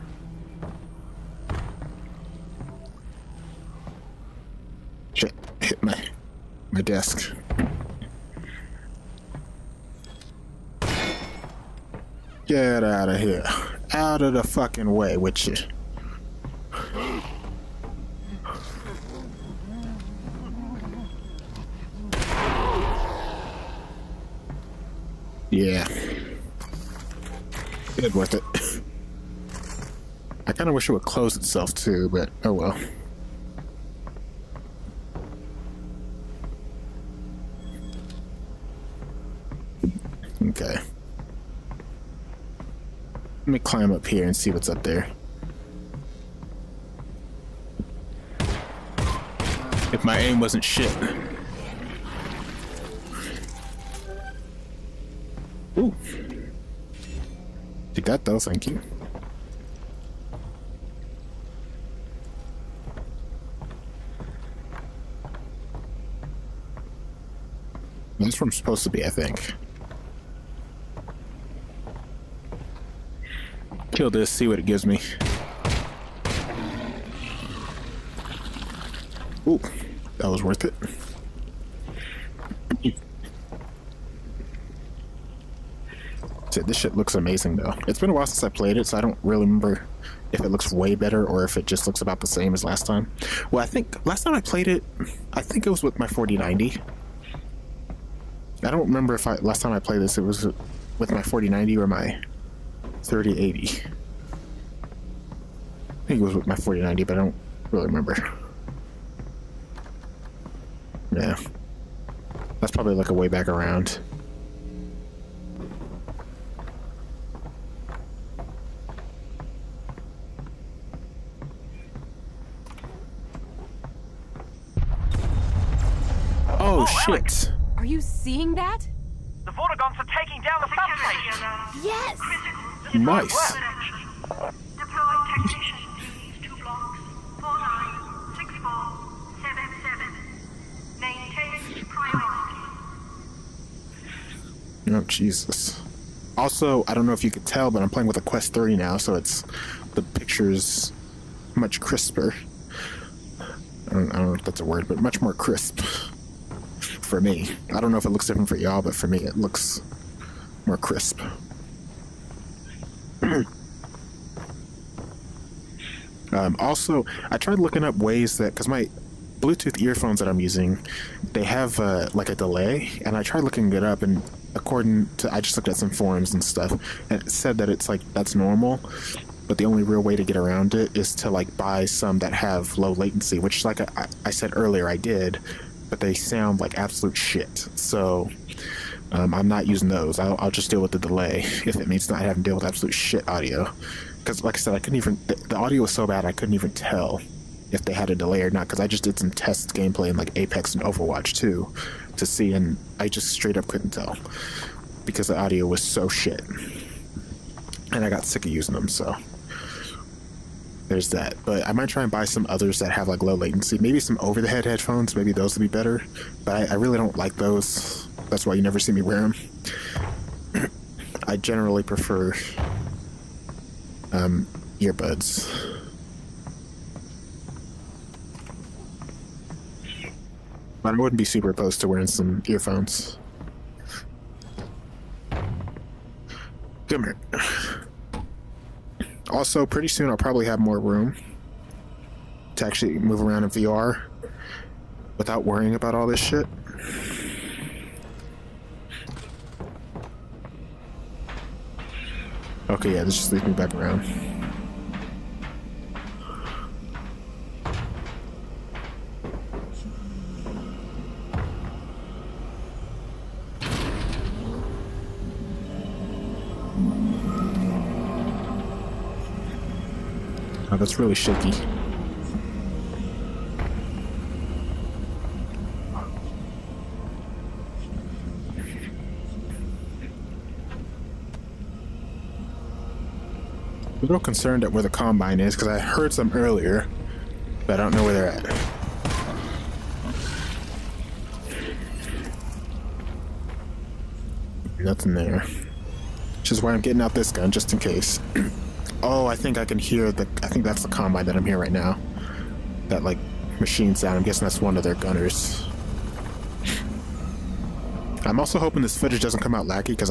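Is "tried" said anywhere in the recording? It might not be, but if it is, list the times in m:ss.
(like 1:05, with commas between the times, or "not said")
2:47, 2:53.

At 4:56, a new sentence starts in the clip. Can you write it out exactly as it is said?
Which is why I'm getting out this gun, just in case.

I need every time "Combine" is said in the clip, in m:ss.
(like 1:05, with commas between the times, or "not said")
4:44, 5:00.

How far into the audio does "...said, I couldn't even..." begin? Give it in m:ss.
3:14.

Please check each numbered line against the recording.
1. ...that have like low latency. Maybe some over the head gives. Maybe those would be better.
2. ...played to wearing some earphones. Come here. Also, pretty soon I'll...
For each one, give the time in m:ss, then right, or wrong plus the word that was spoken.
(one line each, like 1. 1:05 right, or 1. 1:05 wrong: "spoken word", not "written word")
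1. 3:32 wrong: "headphones", not "gives"
2. 3:51 wrong: "opposed", not "played".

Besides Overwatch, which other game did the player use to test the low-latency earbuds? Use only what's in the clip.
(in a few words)
Apex.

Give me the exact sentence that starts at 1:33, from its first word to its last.
Well, I think last time I played it, I think it was with my 4090.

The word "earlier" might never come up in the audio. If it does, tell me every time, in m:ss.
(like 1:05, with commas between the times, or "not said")
3:04, 4:46.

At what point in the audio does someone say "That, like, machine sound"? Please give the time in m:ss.
5:02.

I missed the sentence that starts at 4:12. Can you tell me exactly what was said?
Okay, yeah, this just leads me back around.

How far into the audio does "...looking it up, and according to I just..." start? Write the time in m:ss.
2:53.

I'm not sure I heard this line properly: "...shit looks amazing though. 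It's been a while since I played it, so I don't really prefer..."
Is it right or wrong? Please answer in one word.
wrong.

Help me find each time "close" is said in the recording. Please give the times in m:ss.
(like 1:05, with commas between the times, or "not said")
0:31.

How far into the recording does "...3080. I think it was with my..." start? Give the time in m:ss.
1:43.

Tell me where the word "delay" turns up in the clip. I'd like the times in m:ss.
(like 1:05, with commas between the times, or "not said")
2:52, 3:10, 3:18.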